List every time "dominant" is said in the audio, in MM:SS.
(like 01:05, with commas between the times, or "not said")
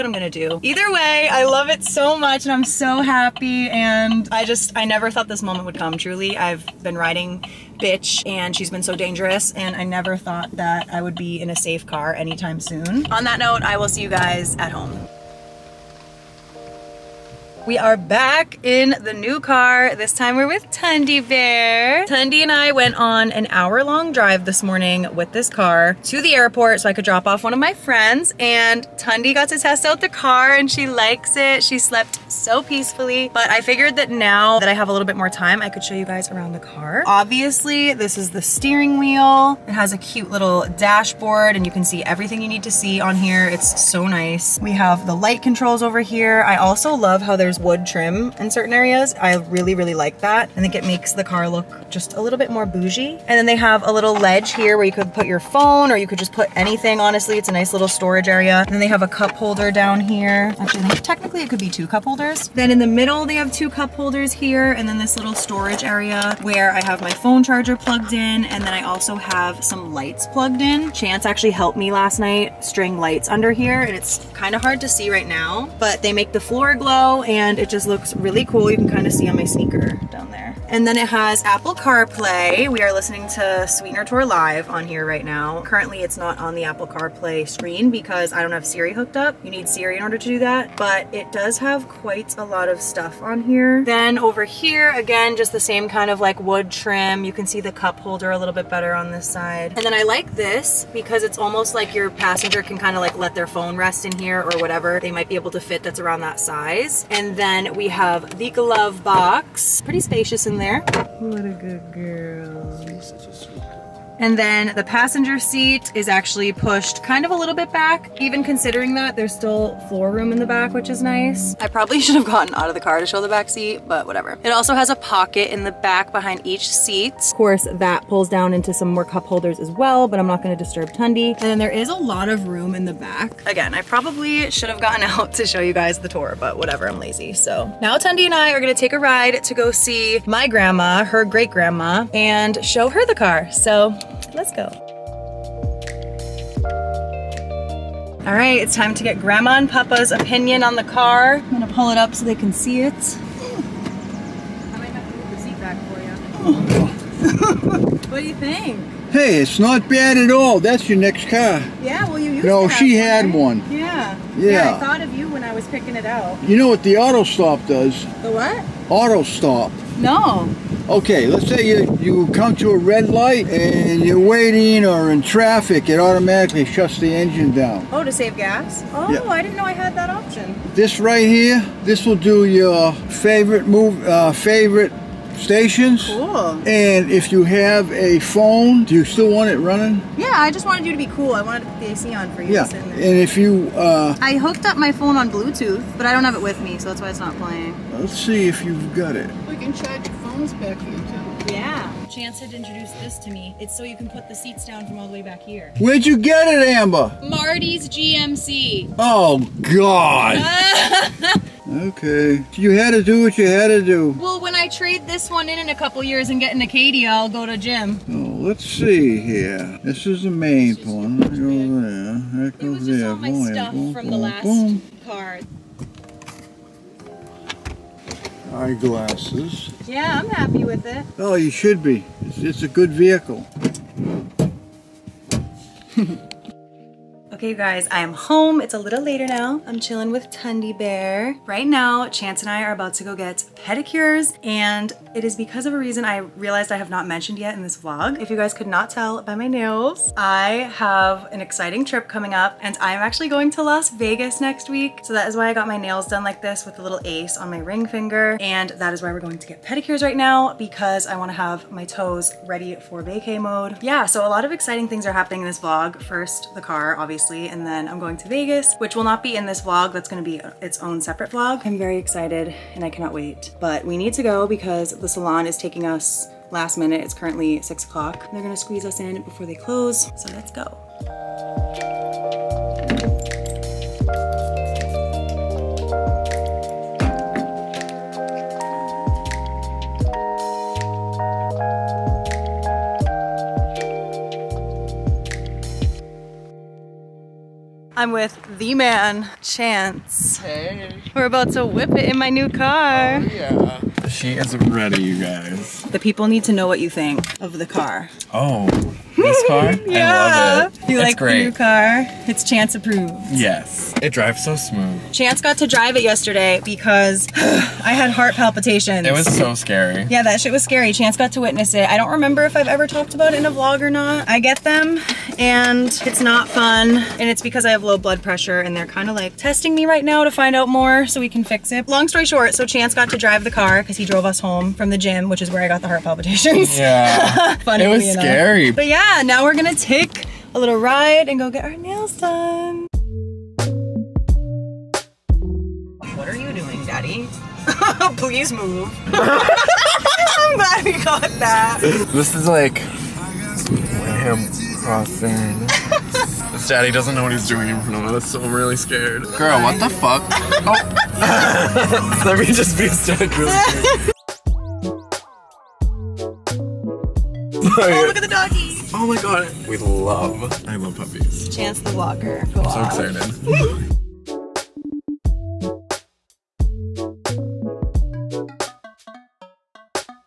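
not said.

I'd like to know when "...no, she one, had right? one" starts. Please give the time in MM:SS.
02:42.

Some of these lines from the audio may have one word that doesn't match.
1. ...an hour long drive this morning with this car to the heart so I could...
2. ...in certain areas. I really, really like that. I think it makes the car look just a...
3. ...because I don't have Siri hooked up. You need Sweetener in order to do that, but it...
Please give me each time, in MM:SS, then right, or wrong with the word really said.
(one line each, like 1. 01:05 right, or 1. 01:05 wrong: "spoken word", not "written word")
1. 00:23 wrong: "airport", not "heart"
2. 00:48 right
3. 01:27 wrong: "Siri", not "Sweetener".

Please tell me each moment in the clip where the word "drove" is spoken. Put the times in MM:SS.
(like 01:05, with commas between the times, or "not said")
05:34.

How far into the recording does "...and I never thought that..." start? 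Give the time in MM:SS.
00:09.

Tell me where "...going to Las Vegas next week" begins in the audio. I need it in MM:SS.
04:13.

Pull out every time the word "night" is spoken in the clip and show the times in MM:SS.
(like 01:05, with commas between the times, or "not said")
01:12.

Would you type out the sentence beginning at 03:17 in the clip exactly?
Let's see if you've got it.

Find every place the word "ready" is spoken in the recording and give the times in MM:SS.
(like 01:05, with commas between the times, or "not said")
04:22, 05:04.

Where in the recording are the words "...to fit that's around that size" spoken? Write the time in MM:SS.
01:45.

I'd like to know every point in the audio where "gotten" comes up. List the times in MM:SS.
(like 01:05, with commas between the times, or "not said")
02:02, 02:14.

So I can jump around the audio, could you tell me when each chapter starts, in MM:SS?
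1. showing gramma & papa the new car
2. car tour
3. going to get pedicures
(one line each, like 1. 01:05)
1. 02:27
2. 00:16
3. 04:56.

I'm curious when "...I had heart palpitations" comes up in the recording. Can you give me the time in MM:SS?
05:17.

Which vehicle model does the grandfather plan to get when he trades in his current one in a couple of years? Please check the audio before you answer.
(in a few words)
Acadia.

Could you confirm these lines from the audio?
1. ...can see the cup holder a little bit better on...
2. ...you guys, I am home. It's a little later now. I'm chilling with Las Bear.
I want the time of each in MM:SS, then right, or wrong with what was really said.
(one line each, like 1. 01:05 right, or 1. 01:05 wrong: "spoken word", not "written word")
1. 01:37 right
2. 03:57 wrong: "Tundi", not "Las".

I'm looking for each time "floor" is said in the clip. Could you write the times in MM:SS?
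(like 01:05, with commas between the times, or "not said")
01:16, 01:59.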